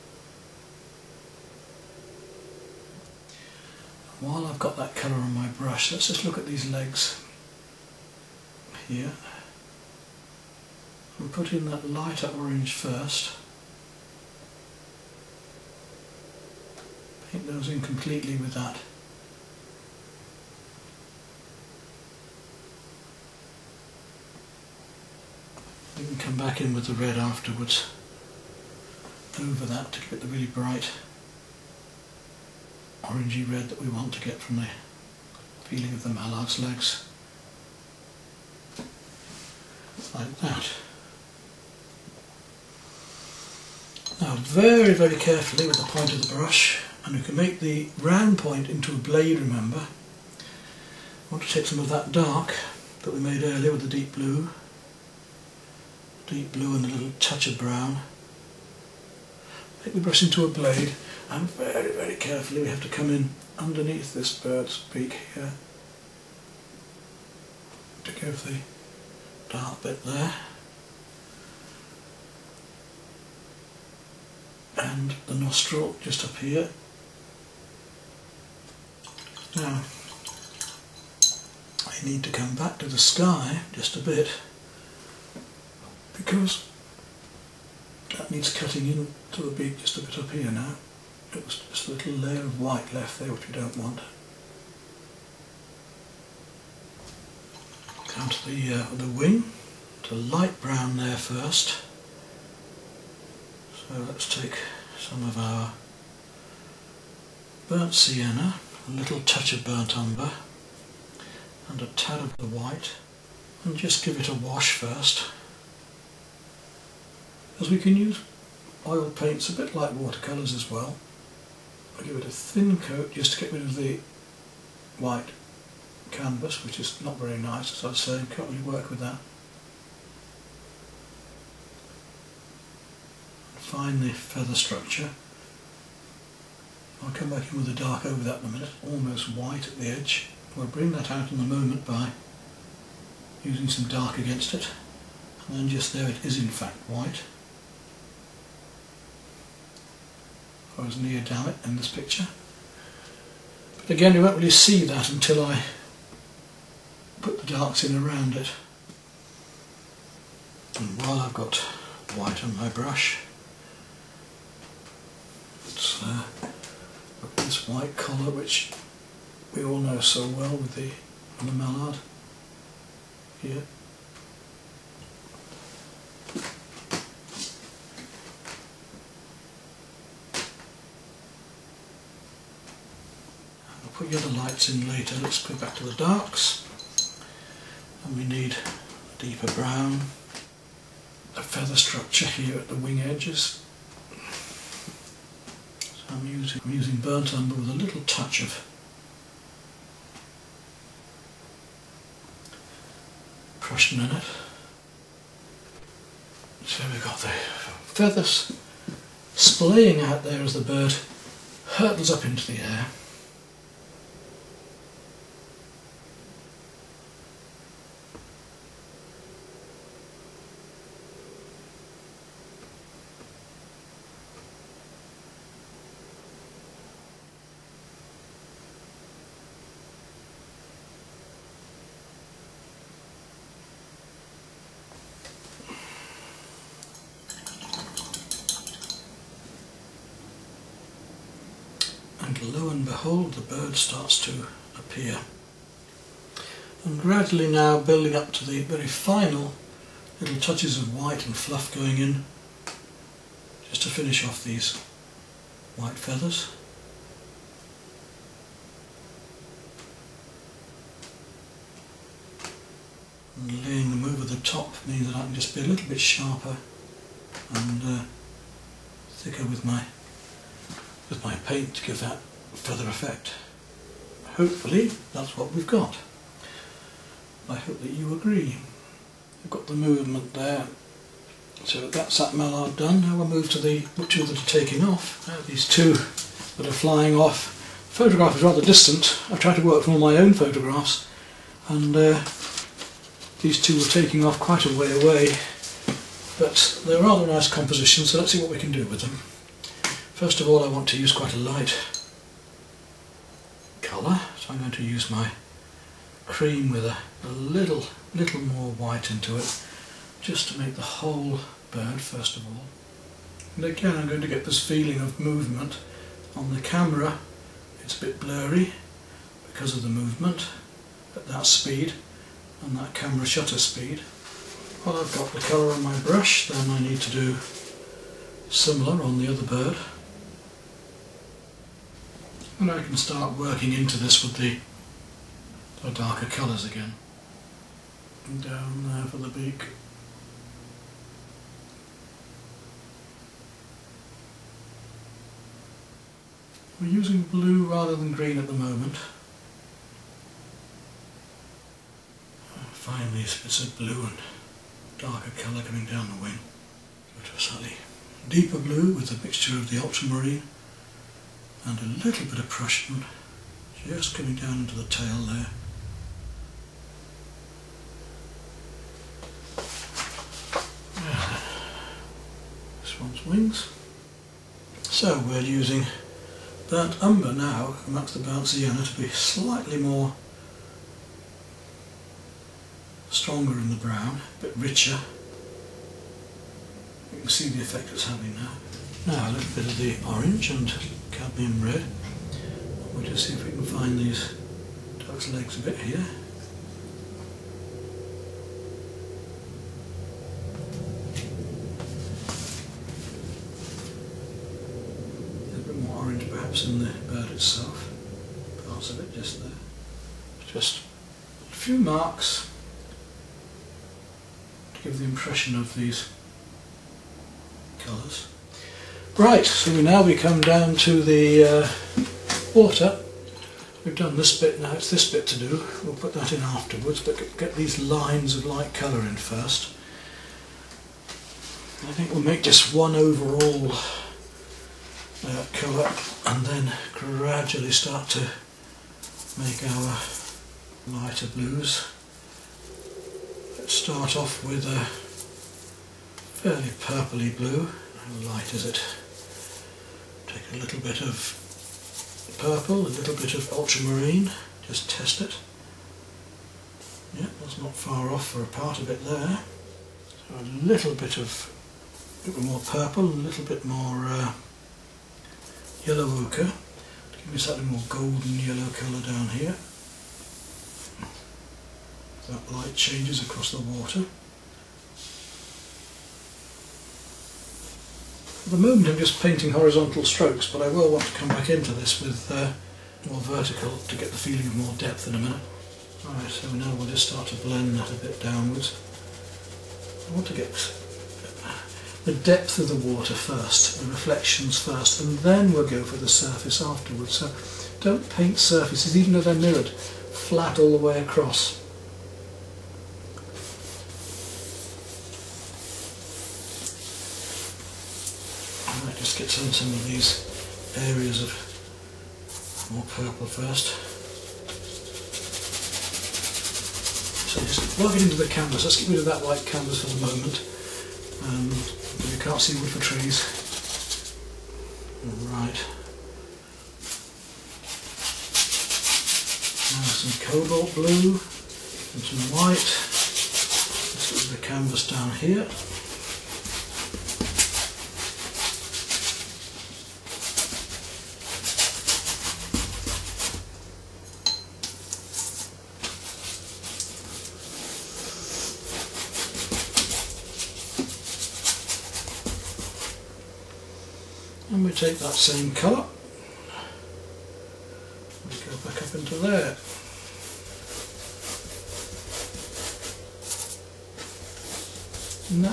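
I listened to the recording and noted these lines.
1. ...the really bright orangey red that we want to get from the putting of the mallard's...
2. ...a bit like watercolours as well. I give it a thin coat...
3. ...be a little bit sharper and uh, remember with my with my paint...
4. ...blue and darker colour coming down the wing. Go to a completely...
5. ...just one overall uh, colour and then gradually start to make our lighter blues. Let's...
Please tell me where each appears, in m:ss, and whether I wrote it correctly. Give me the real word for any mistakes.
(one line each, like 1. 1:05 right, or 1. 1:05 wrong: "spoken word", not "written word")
1. 0:30 wrong: "feeling", not "putting"
2. 1:59 right
3. 4:25 wrong: "thicker", not "remember"
4. 5:53 wrong: "slightly", not "completely"
5. 7:12 right.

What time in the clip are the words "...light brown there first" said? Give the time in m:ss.
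1:40.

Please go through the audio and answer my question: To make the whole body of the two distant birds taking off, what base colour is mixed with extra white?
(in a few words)
Cream.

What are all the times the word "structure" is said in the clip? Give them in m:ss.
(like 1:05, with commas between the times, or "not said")
2:14, 3:11.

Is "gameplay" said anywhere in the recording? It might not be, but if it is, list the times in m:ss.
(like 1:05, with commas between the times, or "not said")
not said.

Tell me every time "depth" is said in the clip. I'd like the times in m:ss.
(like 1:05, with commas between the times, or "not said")
8:04, 8:12.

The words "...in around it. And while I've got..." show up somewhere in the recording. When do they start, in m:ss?
2:37.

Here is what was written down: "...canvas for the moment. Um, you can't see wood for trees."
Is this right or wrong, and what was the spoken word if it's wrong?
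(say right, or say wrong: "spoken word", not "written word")
right.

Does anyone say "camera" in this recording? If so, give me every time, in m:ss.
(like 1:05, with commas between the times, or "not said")
5:16, 5:22.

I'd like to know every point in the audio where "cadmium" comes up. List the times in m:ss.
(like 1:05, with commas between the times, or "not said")
6:31.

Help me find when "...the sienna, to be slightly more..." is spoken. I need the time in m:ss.
6:18.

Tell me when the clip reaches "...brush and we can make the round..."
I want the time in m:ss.
0:46.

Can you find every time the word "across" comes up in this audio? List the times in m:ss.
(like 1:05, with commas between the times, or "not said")
7:53, 8:20.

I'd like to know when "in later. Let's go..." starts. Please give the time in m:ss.
3:04.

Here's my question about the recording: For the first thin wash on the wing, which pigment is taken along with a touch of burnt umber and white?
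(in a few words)
Burnt sienna.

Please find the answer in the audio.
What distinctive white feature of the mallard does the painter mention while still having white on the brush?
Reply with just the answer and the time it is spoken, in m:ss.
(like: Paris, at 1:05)
White collar, at 2:47.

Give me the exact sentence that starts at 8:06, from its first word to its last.
Alright, so now we'll just start to blend that a bit downwards.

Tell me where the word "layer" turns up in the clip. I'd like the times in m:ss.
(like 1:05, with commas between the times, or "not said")
1:32.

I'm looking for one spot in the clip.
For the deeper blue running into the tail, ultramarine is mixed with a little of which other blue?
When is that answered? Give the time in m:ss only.
6:02.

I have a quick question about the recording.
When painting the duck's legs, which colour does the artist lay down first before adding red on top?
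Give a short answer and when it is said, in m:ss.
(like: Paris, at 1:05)
Lighter orange, at 0:11.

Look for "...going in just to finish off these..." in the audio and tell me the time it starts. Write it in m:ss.
4:11.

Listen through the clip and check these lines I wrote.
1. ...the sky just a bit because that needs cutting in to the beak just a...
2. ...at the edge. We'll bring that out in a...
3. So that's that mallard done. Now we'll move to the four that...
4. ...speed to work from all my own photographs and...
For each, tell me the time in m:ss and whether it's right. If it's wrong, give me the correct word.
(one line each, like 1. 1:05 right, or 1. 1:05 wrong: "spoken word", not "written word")
1. 1:22 right
2. 2:19 right
3. 4:41 wrong: "two", not "four"
4. 4:49 wrong: "tried", not "speed".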